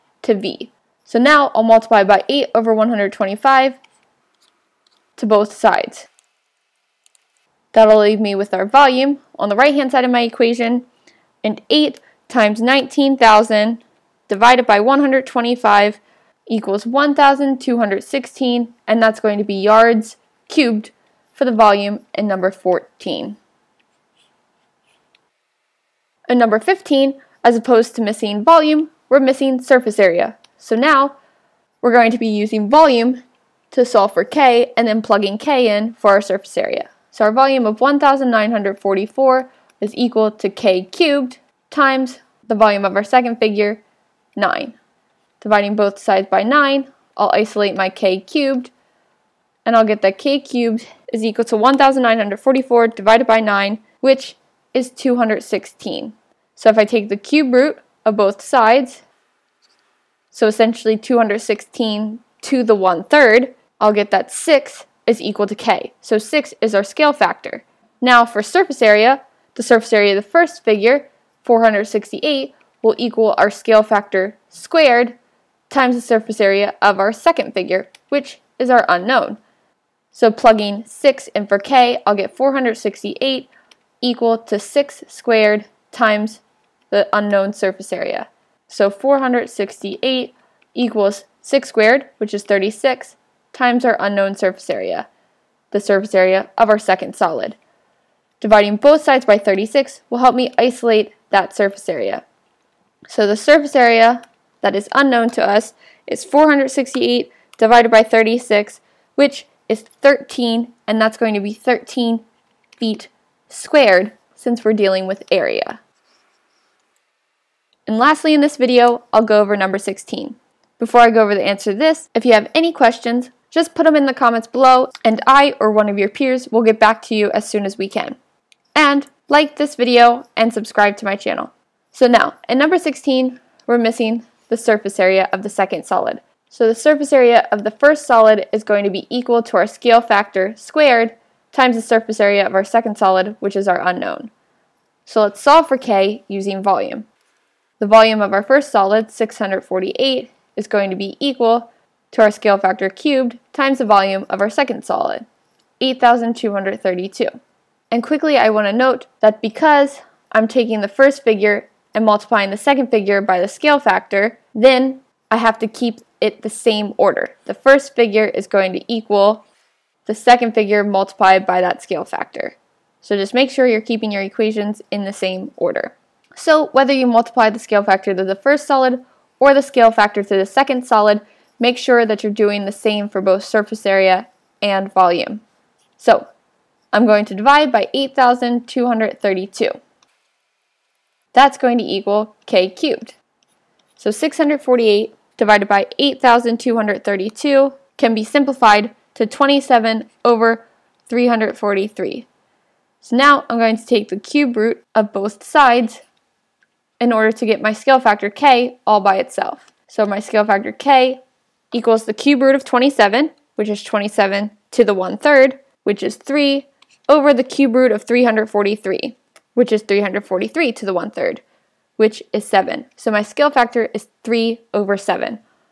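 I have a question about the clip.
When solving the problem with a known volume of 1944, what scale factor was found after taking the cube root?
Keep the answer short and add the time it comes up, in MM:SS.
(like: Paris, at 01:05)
6, at 01:04.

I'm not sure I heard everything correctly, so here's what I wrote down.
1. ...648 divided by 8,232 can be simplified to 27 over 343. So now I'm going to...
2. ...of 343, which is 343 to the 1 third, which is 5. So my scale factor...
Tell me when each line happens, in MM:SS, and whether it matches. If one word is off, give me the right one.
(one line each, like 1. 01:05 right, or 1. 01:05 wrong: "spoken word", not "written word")
1. 03:14 right
2. 03:37 wrong: "7", not "5".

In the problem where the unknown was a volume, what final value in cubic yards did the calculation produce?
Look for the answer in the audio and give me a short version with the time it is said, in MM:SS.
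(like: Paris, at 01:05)
1,216, at 00:16.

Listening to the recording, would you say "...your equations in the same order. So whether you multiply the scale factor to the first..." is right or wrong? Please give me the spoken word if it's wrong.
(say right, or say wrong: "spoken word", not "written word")
right.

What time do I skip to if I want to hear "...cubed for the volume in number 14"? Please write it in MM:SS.
00:20.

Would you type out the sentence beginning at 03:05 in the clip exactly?
So I'm going to divide by 8,232.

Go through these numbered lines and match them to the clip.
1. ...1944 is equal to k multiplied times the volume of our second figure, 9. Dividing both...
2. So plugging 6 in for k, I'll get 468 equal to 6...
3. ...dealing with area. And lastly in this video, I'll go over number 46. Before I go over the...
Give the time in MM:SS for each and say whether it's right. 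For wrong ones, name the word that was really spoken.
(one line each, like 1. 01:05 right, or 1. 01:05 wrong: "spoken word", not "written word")
1. 00:37 wrong: "cubed", not "multiplied"
2. 01:20 right
3. 01:54 wrong: "16", not "46".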